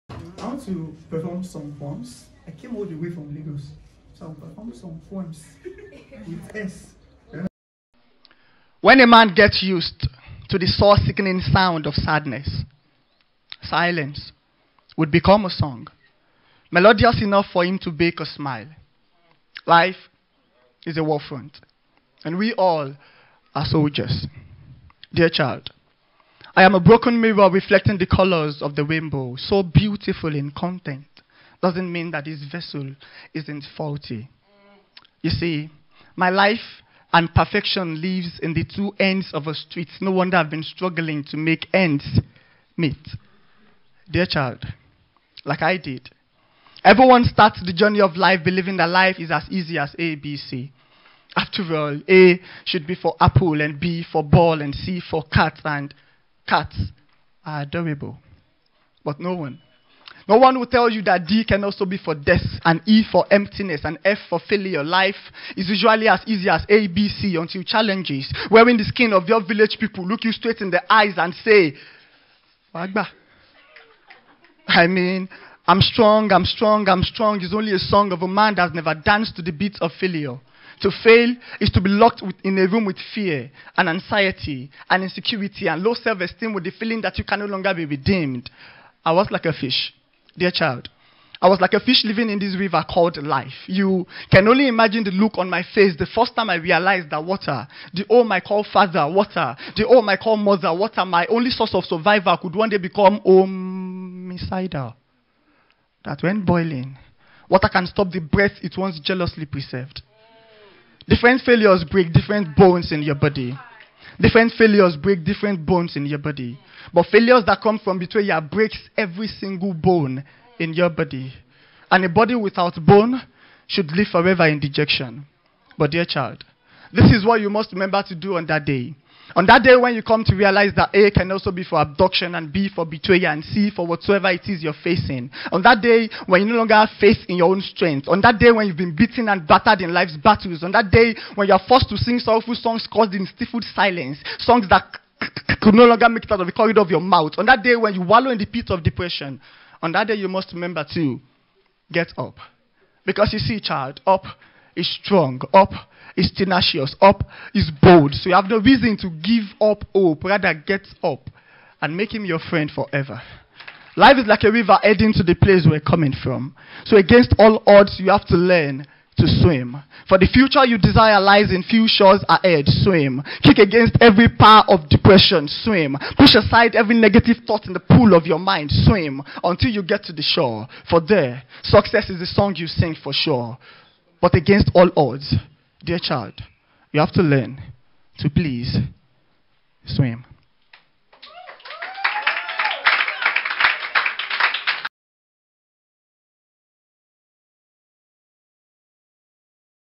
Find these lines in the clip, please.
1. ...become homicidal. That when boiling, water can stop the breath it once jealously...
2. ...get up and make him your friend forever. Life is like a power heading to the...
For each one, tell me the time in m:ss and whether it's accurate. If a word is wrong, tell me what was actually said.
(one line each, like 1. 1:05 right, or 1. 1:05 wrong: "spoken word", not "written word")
1. 1:42 right
2. 2:40 wrong: "river", not "power".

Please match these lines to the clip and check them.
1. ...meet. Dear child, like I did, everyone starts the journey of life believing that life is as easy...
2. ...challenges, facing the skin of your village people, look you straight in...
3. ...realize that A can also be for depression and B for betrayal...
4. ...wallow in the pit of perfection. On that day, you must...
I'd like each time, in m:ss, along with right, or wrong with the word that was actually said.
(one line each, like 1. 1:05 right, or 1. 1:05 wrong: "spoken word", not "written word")
1. 0:42 right
2. 1:07 wrong: "wearing", not "facing"
3. 2:10 wrong: "abduction", not "depression"
4. 2:28 wrong: "depression", not "perfection".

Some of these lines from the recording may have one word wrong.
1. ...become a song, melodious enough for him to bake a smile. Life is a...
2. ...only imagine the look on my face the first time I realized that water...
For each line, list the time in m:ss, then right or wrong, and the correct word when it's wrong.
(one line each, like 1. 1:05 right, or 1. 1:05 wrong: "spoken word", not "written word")
1. 0:15 right
2. 1:34 right.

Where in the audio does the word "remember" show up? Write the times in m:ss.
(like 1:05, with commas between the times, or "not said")
2:07, 2:30.